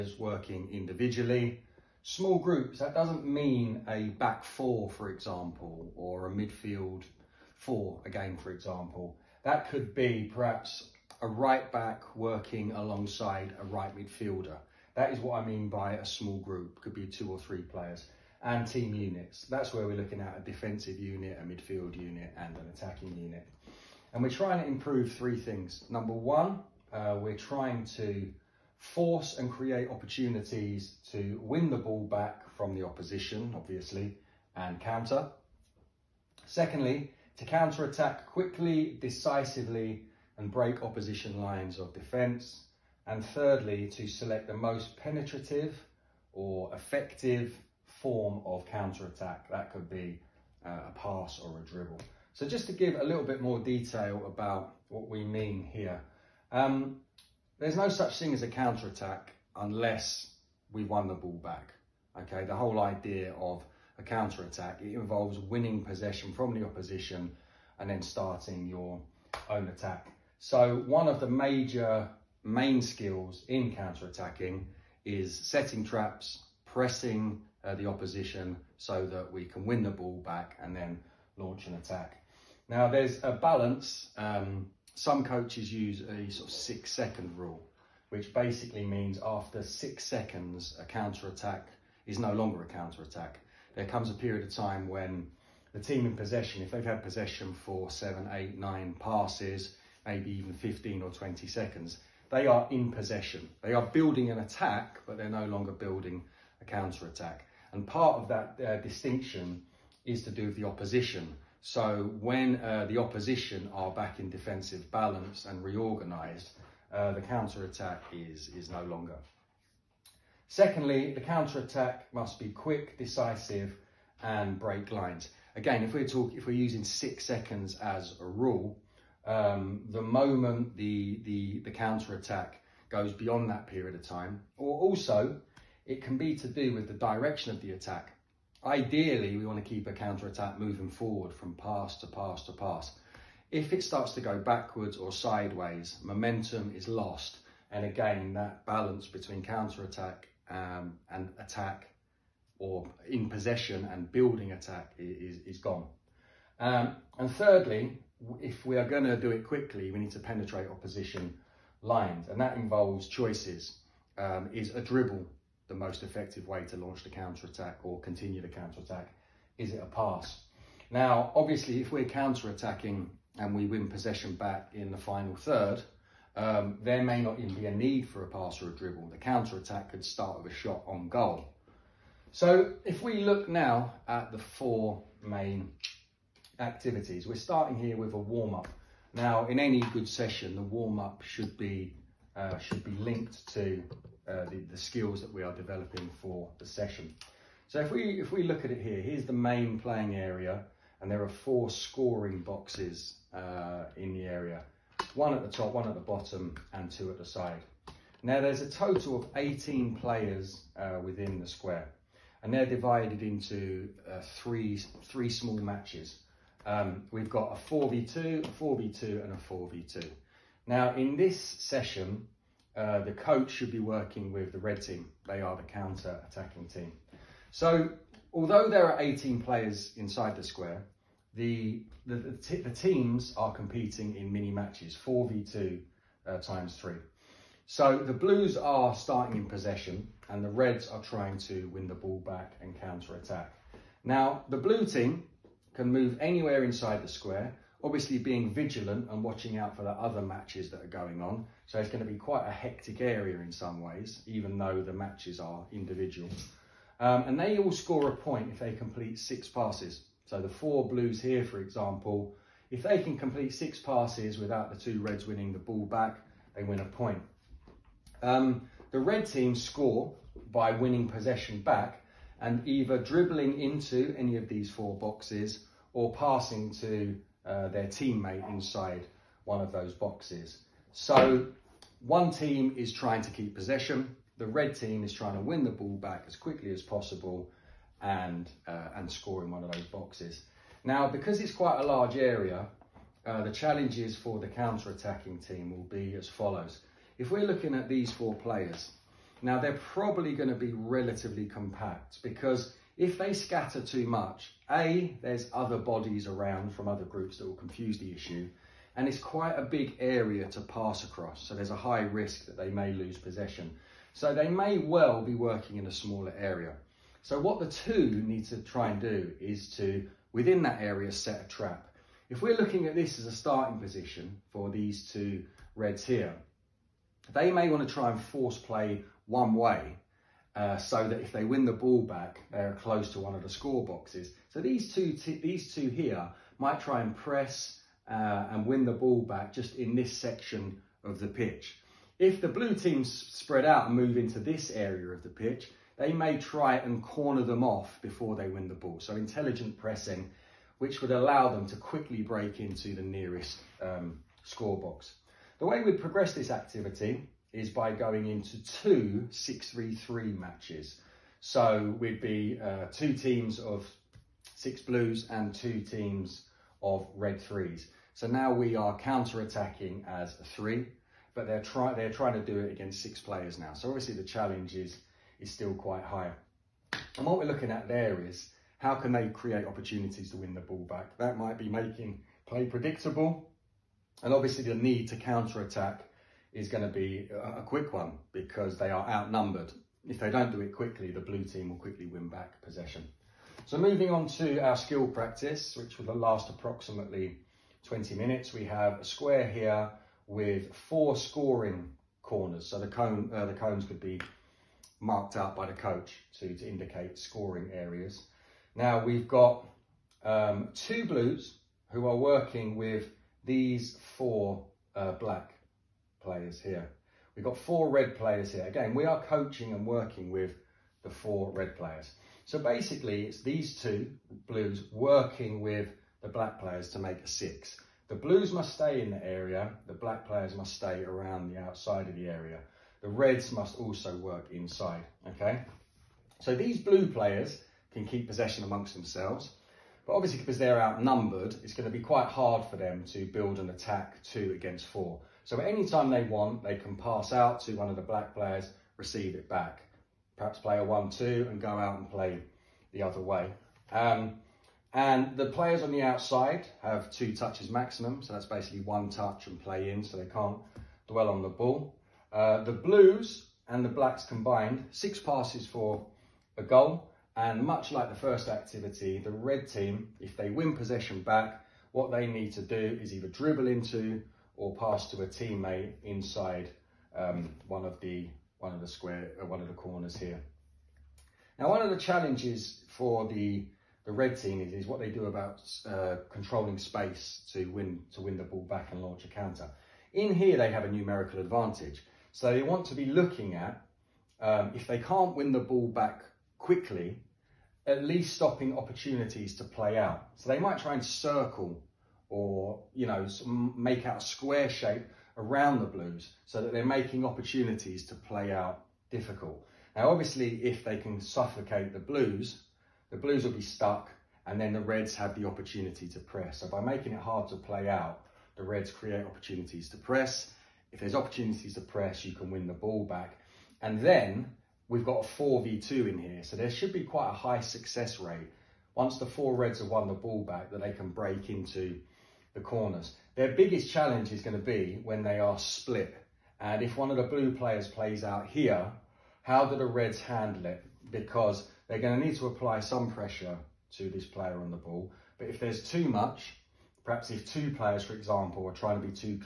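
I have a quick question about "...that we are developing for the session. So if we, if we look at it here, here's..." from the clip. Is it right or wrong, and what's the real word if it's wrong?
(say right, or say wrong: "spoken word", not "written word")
right.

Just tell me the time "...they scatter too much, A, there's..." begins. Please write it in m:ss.
5:03.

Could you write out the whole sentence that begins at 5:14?
So they may well be working in a smaller area.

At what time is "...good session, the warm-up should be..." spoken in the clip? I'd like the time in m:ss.
3:09.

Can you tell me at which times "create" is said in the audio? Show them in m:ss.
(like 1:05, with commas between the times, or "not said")
0:29, 6:19, 8:38.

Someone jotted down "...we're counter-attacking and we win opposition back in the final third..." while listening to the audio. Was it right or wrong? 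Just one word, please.
wrong.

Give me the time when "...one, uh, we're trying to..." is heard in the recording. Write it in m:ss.
0:26.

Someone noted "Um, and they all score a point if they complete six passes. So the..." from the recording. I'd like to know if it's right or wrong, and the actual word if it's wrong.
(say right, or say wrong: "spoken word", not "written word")
right.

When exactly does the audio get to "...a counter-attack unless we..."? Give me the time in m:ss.
0:58.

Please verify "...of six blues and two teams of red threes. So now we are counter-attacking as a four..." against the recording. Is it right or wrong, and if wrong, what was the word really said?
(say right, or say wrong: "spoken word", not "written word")
wrong: "three", not "four".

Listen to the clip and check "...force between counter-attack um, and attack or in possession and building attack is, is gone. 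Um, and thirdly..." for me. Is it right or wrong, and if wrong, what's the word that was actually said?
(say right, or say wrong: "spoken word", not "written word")
wrong: "balance", not "force".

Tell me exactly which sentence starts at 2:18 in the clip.
Ideally, we want to keep a counter-attack moving forward from pass to pass to pass.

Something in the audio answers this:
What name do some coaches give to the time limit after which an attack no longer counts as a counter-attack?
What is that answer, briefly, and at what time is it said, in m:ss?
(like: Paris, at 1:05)
six second rule, at 1:26.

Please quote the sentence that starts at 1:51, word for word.
So when uh, the opposition are back in defensive balance and reorganised, uh, the counter-attack is, is no longer.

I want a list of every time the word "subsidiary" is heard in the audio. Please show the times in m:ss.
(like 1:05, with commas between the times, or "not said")
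not said.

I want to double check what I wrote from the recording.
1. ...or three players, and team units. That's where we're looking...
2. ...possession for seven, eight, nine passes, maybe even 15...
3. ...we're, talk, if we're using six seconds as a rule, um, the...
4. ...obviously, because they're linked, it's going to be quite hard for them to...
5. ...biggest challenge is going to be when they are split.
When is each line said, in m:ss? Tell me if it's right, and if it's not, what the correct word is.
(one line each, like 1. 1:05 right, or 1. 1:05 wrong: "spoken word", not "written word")
1. 0:17 right
2. 1:37 right
3. 2:05 right
4. 7:20 wrong: "outnumbered", not "linked"
5. 8:53 right.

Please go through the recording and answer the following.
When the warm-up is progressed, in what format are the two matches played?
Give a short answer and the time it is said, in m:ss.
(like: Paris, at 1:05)
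6-3-3, at 5:58.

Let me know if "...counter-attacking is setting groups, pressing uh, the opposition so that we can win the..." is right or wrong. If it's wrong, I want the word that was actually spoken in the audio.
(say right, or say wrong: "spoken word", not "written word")
wrong: "traps", not "groups".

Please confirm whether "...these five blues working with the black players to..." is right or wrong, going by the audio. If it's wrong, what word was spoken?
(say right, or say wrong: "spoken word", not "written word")
wrong: "two", not "five".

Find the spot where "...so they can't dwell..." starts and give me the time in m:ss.
7:40.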